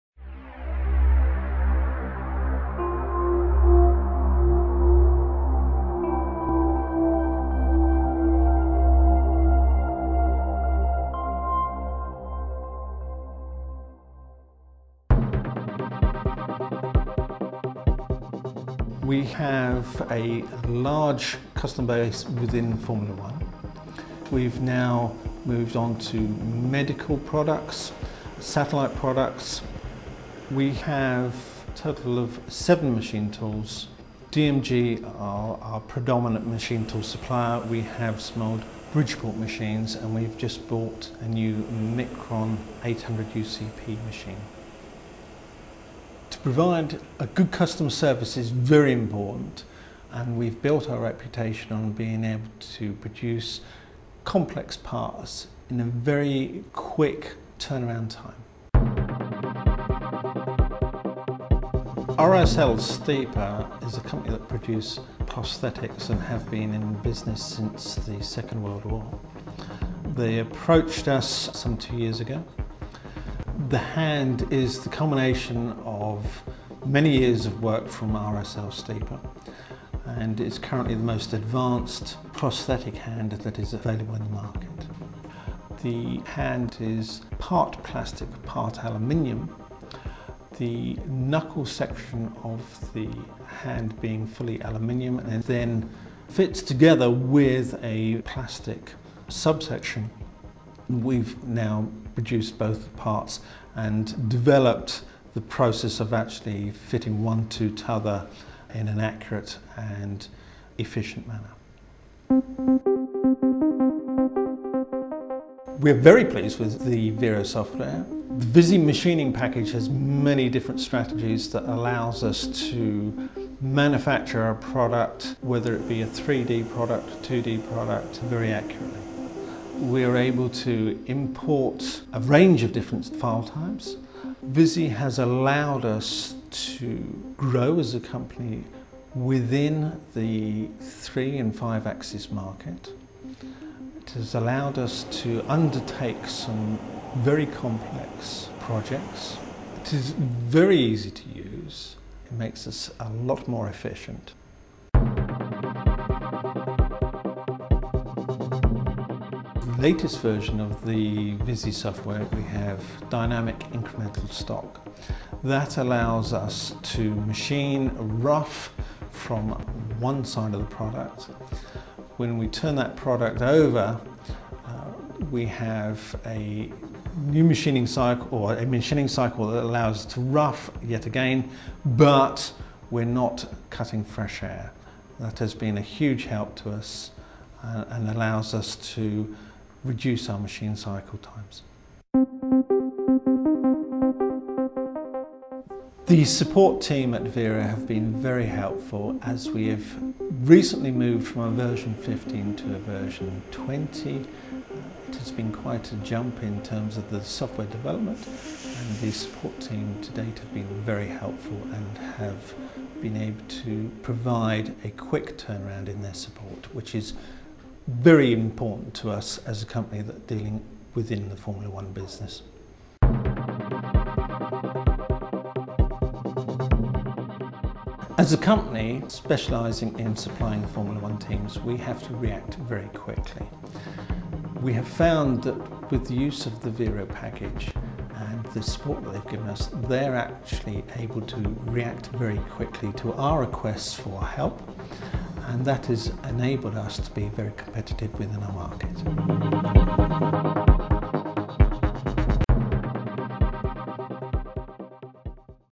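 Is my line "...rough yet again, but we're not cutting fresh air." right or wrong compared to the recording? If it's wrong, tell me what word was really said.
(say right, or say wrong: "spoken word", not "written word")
right.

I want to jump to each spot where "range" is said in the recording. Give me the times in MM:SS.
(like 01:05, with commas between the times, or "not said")
02:12.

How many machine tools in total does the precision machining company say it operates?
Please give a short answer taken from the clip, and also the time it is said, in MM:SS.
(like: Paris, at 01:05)
7, at 00:32.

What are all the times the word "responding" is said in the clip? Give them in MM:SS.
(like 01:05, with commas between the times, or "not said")
not said.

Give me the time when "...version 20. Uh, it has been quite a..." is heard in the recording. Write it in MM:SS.
03:22.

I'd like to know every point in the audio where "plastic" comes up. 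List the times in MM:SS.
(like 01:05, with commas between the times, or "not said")
01:27, 01:38.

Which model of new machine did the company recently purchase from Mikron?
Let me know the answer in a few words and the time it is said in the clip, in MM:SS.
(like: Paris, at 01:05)
800 UCP, at 00:42.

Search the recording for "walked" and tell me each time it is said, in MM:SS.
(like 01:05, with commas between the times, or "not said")
not said.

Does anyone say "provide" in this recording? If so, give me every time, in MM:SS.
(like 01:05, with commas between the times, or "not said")
00:46, 03:34.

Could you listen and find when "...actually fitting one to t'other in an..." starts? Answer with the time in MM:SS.
01:46.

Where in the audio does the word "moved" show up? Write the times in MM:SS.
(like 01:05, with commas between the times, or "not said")
00:25, 03:20.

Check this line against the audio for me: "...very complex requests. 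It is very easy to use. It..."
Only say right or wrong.
wrong.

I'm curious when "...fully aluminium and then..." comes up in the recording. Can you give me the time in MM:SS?
01:34.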